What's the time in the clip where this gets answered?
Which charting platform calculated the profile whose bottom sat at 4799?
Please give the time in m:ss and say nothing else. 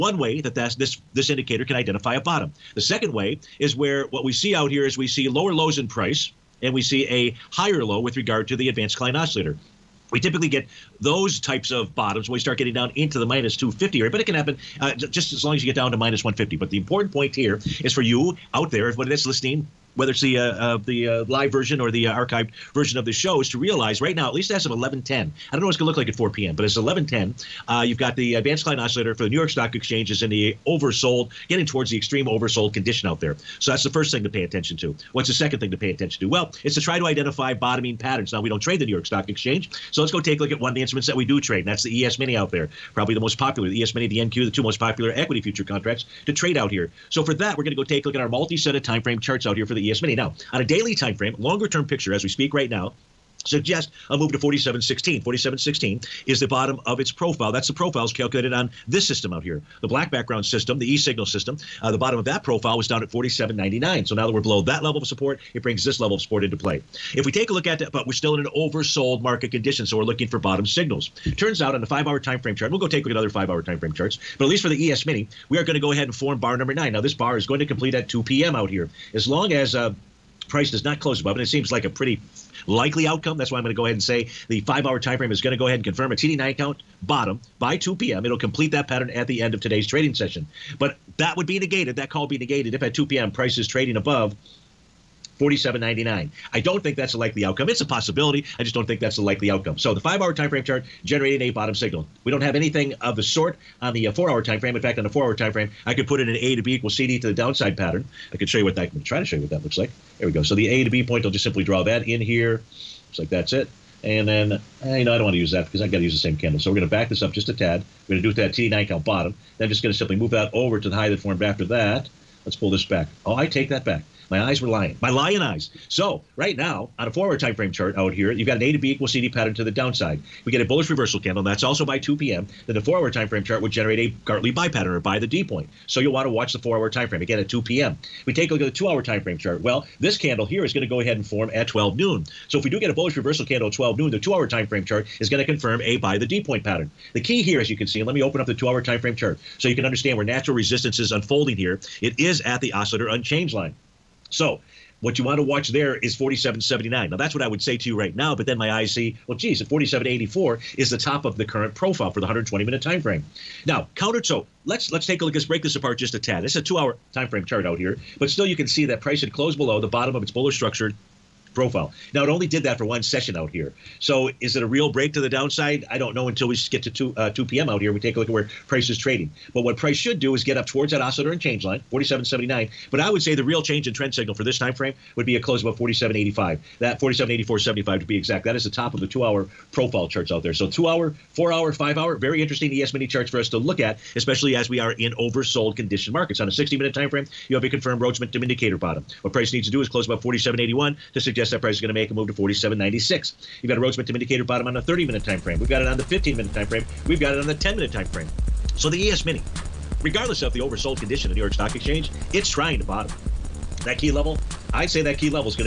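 1:00.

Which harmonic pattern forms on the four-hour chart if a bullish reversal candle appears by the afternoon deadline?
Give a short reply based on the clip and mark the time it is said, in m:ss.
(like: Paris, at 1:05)
Gartley buy pattern, at 2:14.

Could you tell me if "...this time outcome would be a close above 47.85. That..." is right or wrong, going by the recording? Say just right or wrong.
wrong.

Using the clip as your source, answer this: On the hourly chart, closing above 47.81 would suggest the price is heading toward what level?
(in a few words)
47.96.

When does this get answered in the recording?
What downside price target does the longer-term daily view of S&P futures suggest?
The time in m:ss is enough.
0:53.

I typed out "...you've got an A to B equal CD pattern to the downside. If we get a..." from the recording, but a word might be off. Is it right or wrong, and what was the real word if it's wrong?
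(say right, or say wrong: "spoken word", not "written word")
right.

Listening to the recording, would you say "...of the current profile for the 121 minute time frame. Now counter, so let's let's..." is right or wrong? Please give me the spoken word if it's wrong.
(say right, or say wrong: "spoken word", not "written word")
wrong: "120", not "121".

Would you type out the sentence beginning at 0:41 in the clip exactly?
And that's that's the ES Mini out there, probably the most popular.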